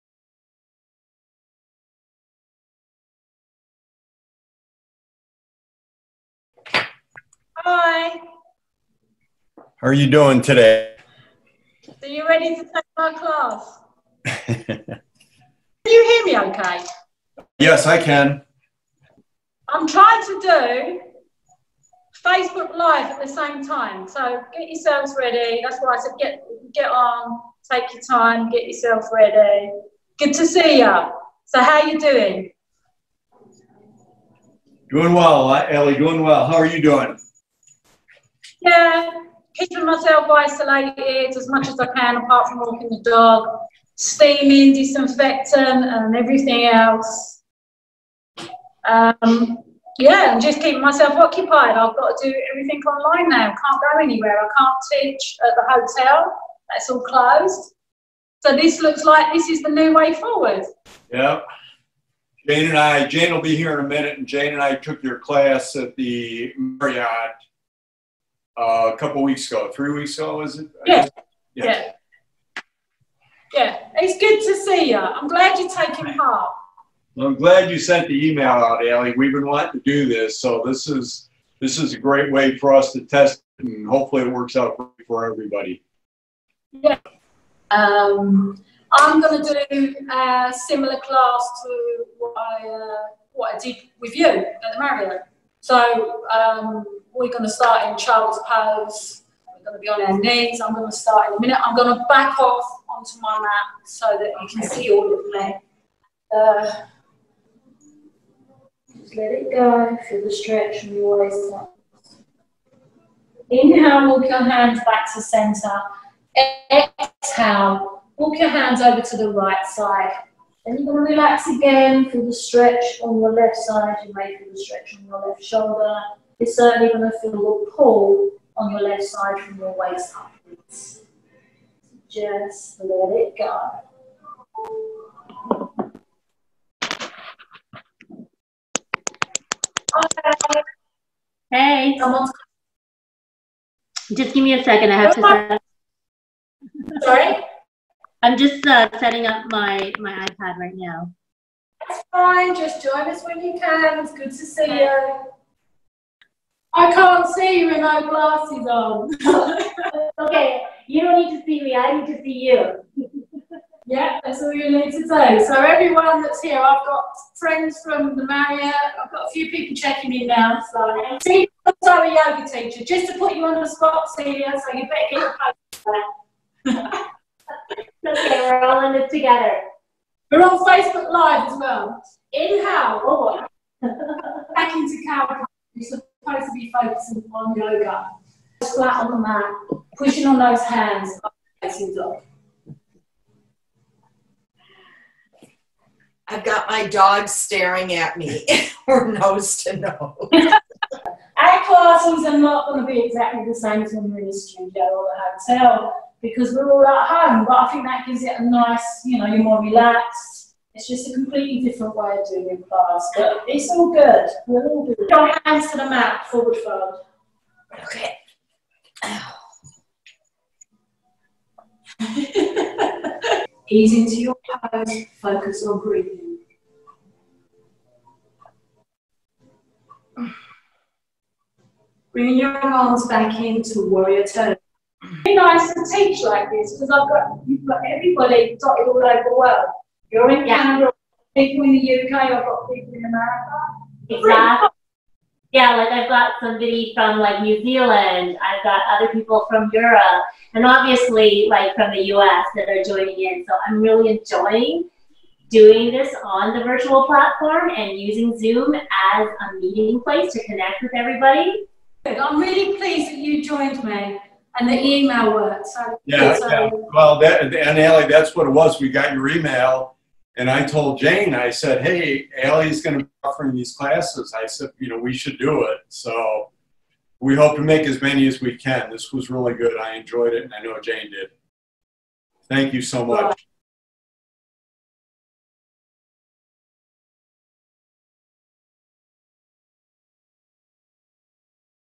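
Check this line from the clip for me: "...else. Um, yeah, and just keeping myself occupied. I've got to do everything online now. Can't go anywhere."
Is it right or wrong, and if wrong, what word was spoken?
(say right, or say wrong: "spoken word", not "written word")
right.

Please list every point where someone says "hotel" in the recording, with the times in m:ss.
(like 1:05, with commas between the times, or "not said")
0:55, 3:25.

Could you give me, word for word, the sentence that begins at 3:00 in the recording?
We're on Facebook Live as well.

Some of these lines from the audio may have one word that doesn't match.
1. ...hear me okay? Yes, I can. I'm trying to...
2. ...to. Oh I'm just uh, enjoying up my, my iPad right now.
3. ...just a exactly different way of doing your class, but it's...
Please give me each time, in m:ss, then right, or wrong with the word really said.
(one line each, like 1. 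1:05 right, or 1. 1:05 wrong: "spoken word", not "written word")
1. 0:16 right
2. 2:25 wrong: "setting", not "enjoying"
3. 3:30 wrong: "completely", not "exactly".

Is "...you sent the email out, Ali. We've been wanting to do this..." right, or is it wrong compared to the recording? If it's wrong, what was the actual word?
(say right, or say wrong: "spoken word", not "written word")
right.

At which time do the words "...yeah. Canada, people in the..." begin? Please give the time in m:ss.
4:00.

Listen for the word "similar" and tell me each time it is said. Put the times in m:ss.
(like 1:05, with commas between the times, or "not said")
1:30.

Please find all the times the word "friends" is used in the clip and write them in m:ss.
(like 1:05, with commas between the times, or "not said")
2:47.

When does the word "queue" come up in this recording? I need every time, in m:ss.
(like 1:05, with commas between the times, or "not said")
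not said.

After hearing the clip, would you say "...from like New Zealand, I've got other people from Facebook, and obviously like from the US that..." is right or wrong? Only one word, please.
wrong.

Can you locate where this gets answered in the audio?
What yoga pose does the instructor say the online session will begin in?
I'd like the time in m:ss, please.
1:37.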